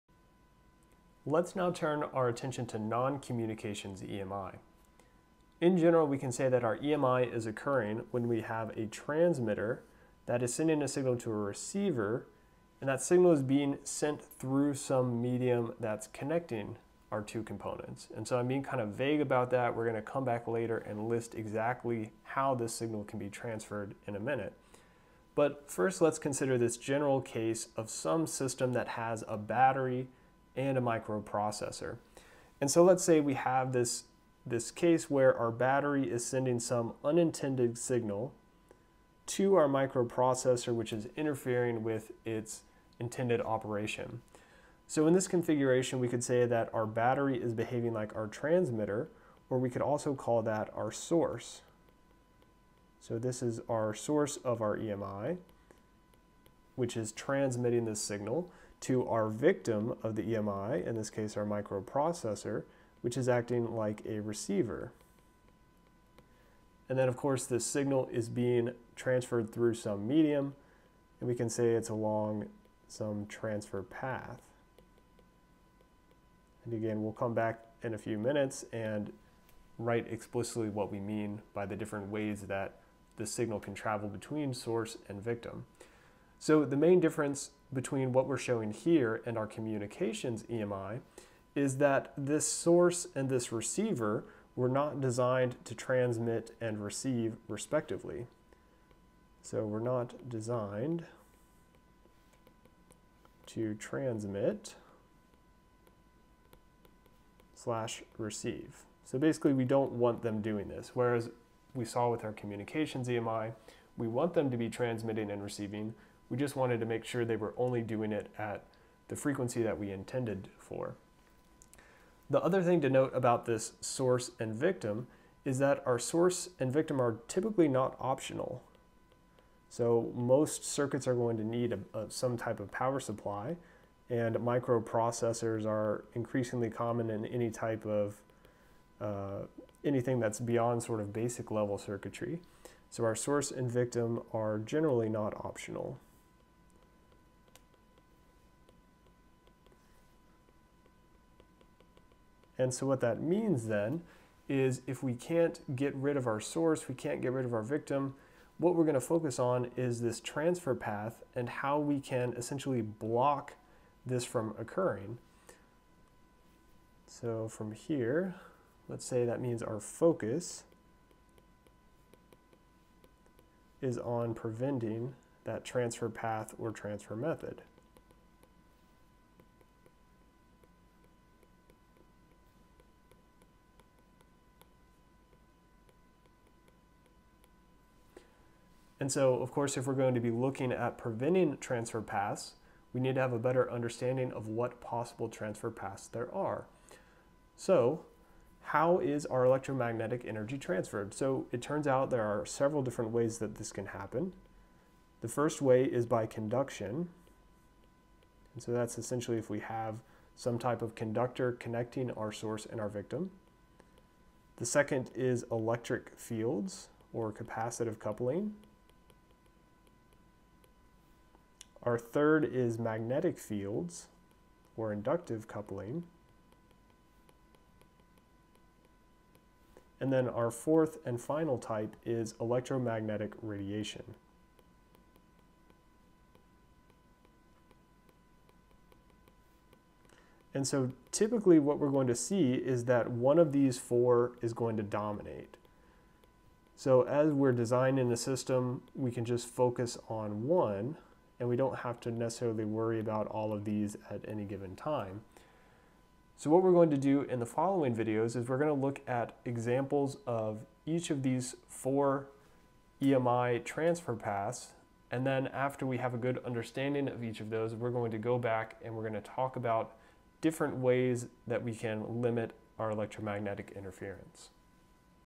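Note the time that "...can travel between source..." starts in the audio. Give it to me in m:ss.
1:23.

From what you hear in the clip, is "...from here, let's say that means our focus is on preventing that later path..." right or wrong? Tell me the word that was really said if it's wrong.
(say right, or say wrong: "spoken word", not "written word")
wrong: "transfer", not "later".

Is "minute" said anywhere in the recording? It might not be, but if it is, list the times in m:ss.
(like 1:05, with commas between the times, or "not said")
0:24, 1:18.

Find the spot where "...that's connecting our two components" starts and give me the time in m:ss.
0:15.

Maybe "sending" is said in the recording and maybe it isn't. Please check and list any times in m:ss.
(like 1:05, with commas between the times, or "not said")
0:10, 0:36.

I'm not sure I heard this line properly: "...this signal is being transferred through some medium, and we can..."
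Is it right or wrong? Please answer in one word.
right.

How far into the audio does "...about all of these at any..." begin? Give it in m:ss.
4:12.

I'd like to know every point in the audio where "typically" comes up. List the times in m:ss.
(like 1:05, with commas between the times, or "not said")
2:07, 4:01.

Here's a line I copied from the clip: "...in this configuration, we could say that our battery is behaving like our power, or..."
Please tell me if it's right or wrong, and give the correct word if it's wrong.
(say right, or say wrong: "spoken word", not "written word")
wrong: "transmitter", not "power".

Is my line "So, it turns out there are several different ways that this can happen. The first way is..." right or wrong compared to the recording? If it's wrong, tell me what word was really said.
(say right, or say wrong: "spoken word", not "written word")
right.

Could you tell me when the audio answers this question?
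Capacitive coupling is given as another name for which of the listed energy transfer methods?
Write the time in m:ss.
3:35.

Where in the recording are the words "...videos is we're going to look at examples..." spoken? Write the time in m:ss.
4:17.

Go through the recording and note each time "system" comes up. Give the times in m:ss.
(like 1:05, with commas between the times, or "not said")
0:28, 4:08.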